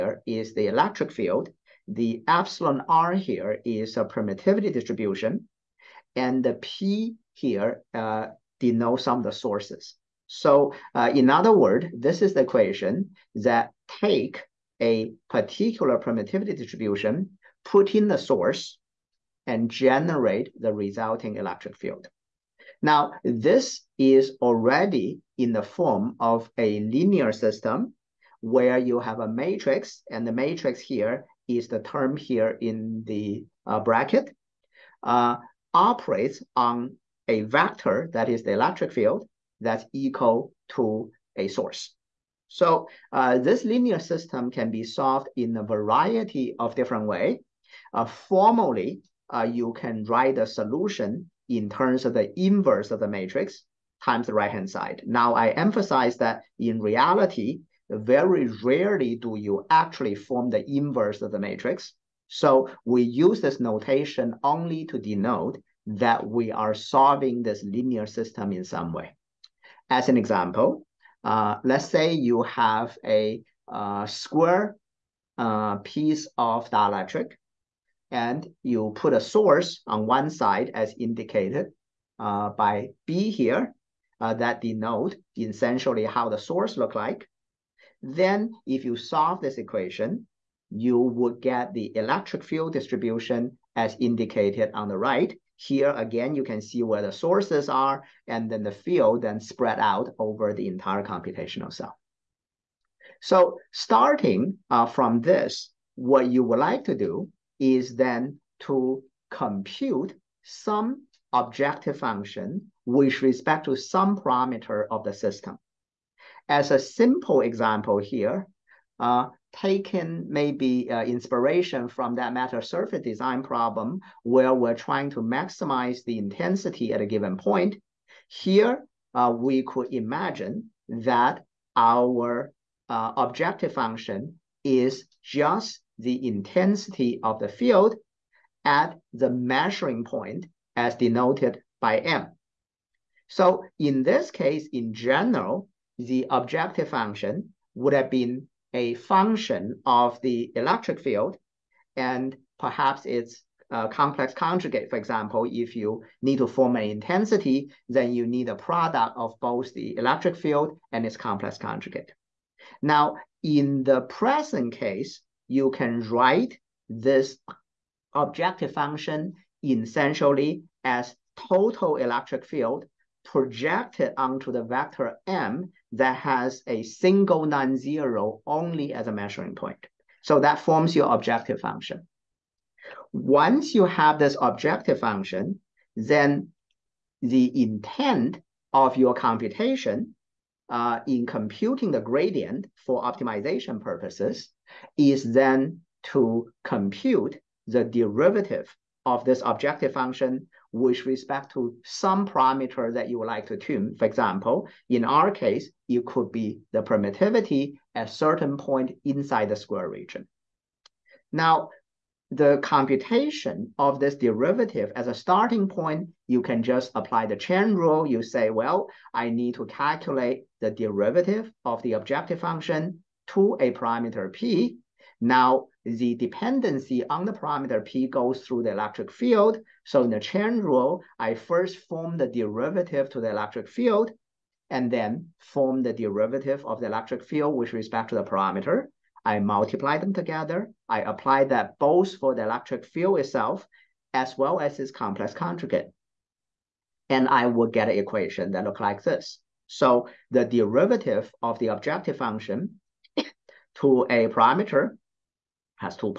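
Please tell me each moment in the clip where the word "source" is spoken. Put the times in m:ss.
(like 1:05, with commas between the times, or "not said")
0:09, 0:18, 0:41, 1:19, 1:26, 1:37.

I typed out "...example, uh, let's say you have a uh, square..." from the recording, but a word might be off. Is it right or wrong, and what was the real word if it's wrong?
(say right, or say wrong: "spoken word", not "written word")
right.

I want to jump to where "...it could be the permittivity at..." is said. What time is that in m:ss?
3:25.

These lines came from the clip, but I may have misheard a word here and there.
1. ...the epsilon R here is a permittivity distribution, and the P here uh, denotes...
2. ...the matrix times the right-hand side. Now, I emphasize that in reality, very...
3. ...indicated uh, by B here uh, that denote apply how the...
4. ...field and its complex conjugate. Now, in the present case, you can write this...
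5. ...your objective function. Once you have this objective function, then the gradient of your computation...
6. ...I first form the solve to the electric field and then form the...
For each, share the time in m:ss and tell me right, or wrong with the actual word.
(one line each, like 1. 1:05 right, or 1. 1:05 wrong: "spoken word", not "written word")
1. 0:01 right
2. 0:52 right
3. 1:20 wrong: "essentially", not "apply"
4. 2:40 right
5. 3:00 wrong: "intent", not "gradient"
6. 3:51 wrong: "derivative", not "solve".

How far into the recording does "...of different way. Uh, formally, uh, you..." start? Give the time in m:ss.
0:46.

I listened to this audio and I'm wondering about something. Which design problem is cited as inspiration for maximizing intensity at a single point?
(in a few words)
metasurface design.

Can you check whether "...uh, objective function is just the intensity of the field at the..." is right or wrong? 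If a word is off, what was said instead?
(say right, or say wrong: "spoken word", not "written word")
right.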